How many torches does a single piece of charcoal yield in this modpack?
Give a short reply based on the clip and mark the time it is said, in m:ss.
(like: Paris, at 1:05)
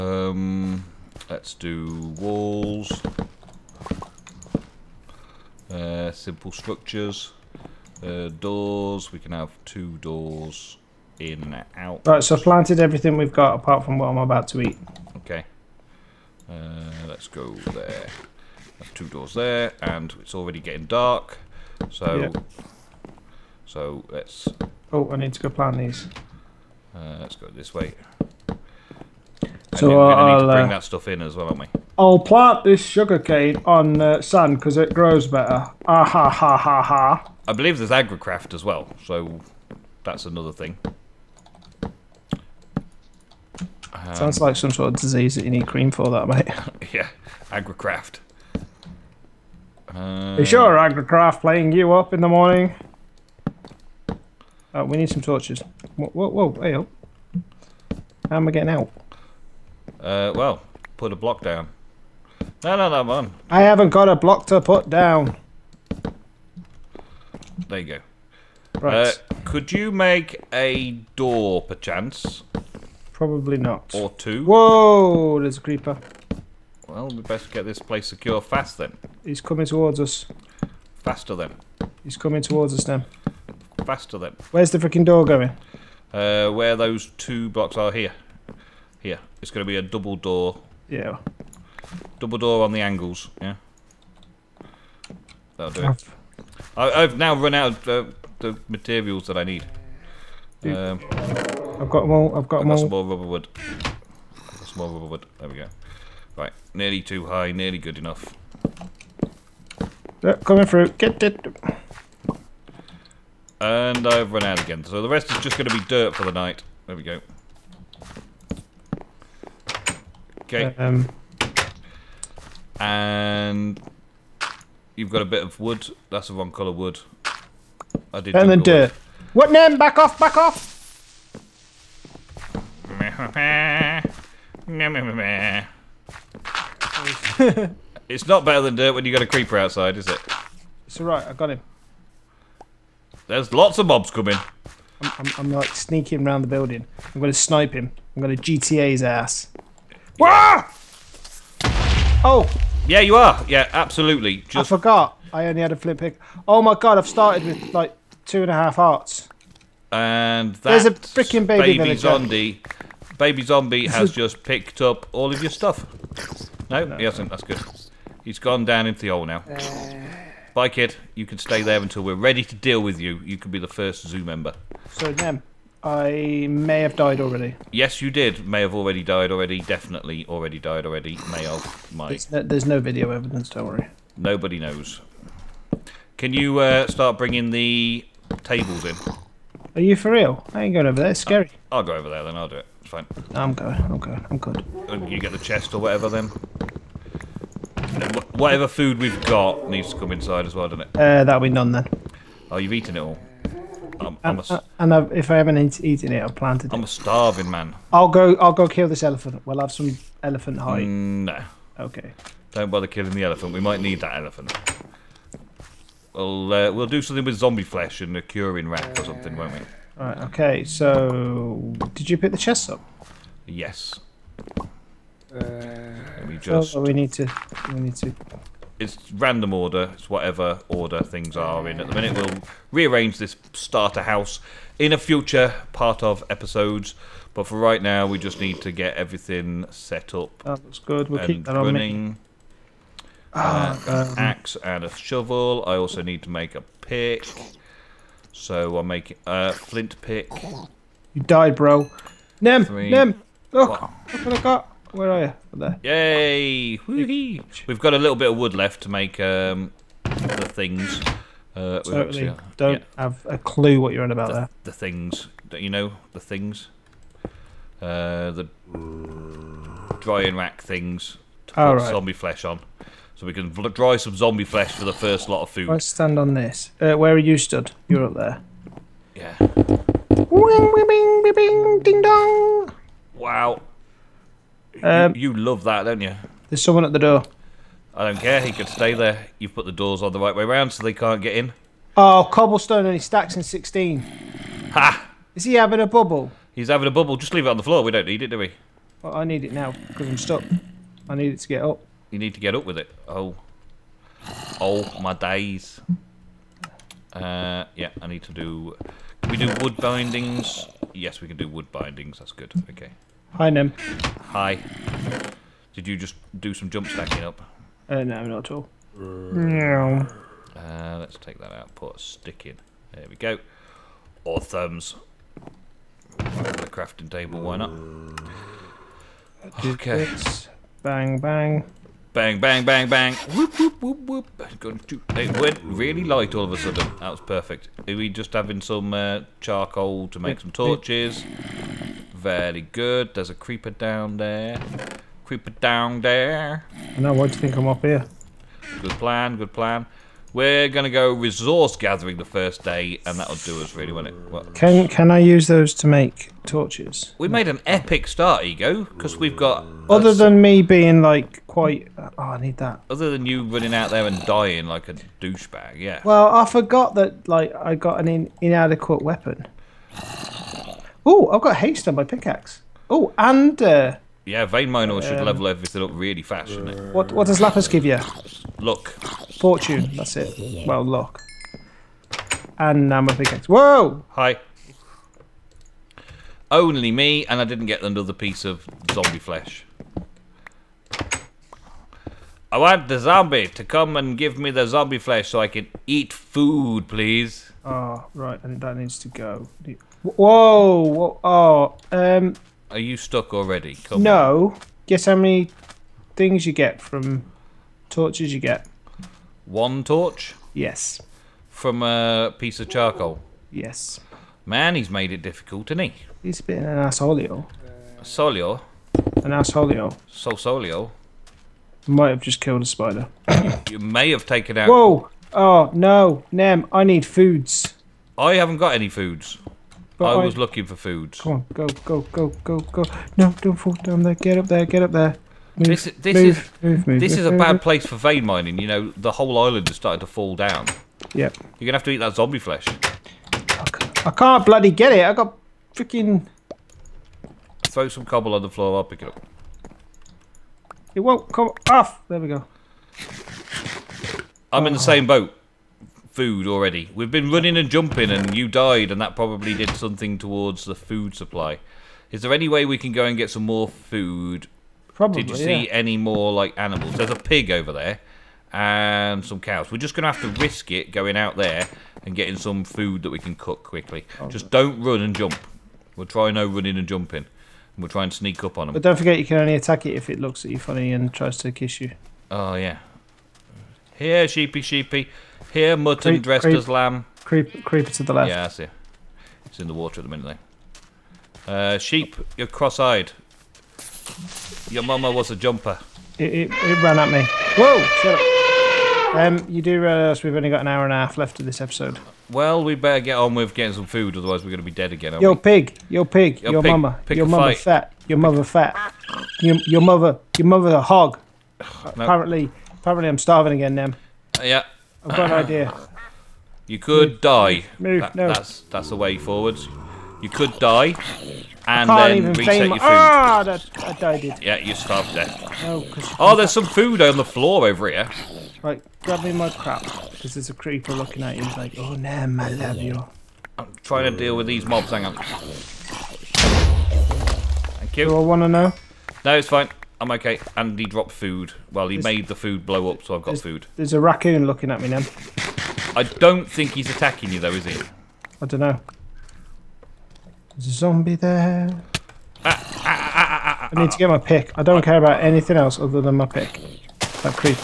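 1, at 6:49.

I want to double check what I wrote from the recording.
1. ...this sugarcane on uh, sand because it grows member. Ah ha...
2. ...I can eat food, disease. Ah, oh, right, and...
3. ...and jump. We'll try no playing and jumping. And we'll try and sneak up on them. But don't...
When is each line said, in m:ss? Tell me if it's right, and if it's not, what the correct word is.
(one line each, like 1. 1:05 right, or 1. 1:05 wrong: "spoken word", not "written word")
1. 0:32 wrong: "better", not "member"
2. 6:35 wrong: "please", not "disease"
3. 7:55 wrong: "running", not "playing".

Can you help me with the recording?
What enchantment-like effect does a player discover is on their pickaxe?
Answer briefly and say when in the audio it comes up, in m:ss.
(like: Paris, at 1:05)
Haste, at 6:11.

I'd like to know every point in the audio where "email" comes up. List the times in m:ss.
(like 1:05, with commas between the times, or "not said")
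not said.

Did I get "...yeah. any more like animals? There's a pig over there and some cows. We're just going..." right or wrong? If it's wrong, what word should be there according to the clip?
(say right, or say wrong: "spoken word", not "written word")
right.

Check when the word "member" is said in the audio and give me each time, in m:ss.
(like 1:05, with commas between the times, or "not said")
2:54.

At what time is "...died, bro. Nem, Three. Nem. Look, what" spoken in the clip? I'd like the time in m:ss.
4:11.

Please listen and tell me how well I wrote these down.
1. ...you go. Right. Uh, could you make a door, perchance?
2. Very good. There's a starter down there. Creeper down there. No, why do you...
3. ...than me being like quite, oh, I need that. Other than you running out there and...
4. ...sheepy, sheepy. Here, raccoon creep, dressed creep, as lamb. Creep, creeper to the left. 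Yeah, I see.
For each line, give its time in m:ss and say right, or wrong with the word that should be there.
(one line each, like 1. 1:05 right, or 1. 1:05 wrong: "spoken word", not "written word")
1. 1:07 right
2. 5:42 wrong: "creeper", not "starter"
3. 6:00 right
4. 8:04 wrong: "mutton", not "raccoon".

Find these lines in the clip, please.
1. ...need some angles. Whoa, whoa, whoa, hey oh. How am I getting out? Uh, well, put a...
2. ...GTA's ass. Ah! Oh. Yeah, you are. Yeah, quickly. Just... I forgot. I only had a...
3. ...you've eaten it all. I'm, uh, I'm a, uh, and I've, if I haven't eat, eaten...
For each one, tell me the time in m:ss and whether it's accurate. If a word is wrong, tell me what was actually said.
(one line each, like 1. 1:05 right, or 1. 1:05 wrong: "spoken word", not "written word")
1. 0:54 wrong: "torches", not "angles"
2. 2:28 wrong: "absolutely", not "quickly"
3. 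3:22 right.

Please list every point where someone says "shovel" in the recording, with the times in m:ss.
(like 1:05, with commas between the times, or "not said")
4:04.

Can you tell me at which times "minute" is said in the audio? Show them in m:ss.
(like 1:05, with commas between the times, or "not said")
3:51, 8:10.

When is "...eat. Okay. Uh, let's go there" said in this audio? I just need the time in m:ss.
0:14.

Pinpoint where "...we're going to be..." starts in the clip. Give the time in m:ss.
8:24.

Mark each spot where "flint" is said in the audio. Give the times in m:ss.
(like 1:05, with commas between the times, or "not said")
2:35, 4:09.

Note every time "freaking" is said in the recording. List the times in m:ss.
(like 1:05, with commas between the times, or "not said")
1:24, 2:40, 7:25.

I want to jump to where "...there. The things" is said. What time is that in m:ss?
4:24.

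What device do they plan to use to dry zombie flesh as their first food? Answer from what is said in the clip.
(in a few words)
Curing rack.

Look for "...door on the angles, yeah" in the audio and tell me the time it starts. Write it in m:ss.
1:32.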